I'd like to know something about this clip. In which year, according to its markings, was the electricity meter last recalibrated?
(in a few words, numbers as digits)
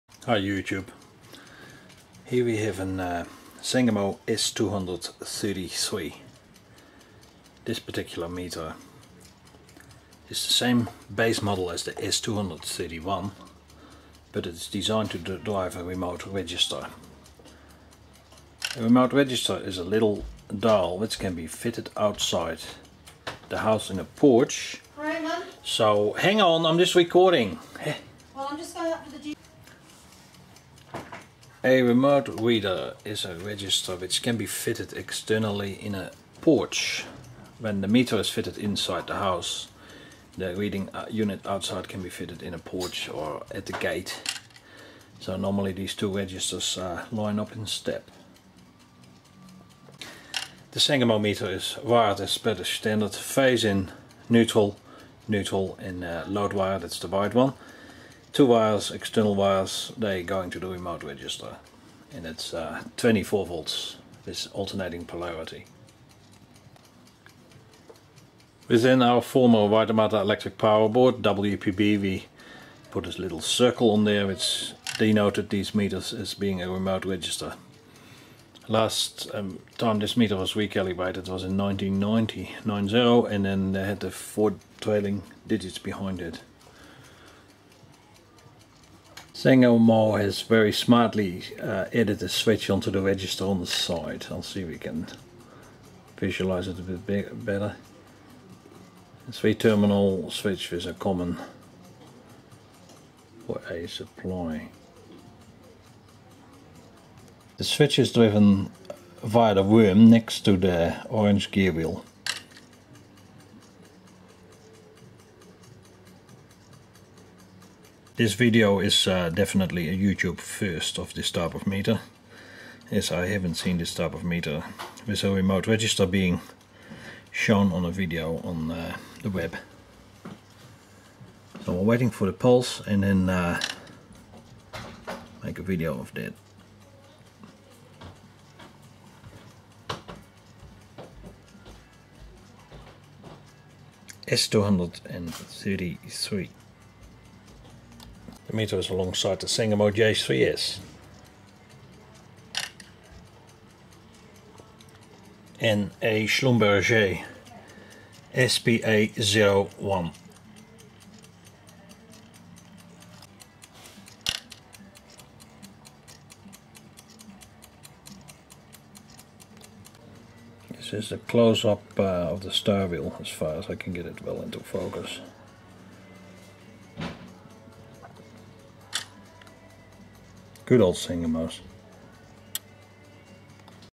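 1990.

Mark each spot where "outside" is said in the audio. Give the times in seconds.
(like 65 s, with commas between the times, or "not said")
21 s, 41 s.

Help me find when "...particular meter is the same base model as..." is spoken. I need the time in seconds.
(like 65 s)
7 s.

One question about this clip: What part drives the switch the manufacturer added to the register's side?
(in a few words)
The worm.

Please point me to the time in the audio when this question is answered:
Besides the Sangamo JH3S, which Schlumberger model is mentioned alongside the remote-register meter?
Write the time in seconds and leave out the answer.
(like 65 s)
158 s.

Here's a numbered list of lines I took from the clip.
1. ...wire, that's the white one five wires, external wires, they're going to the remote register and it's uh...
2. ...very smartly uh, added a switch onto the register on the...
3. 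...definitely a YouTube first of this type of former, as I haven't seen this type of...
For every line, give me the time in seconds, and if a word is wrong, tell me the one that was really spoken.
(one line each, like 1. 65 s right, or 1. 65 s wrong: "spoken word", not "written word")
1. 56 s wrong: "two", not "five"
2. 90 s right
3. 119 s wrong: "meter", not "former".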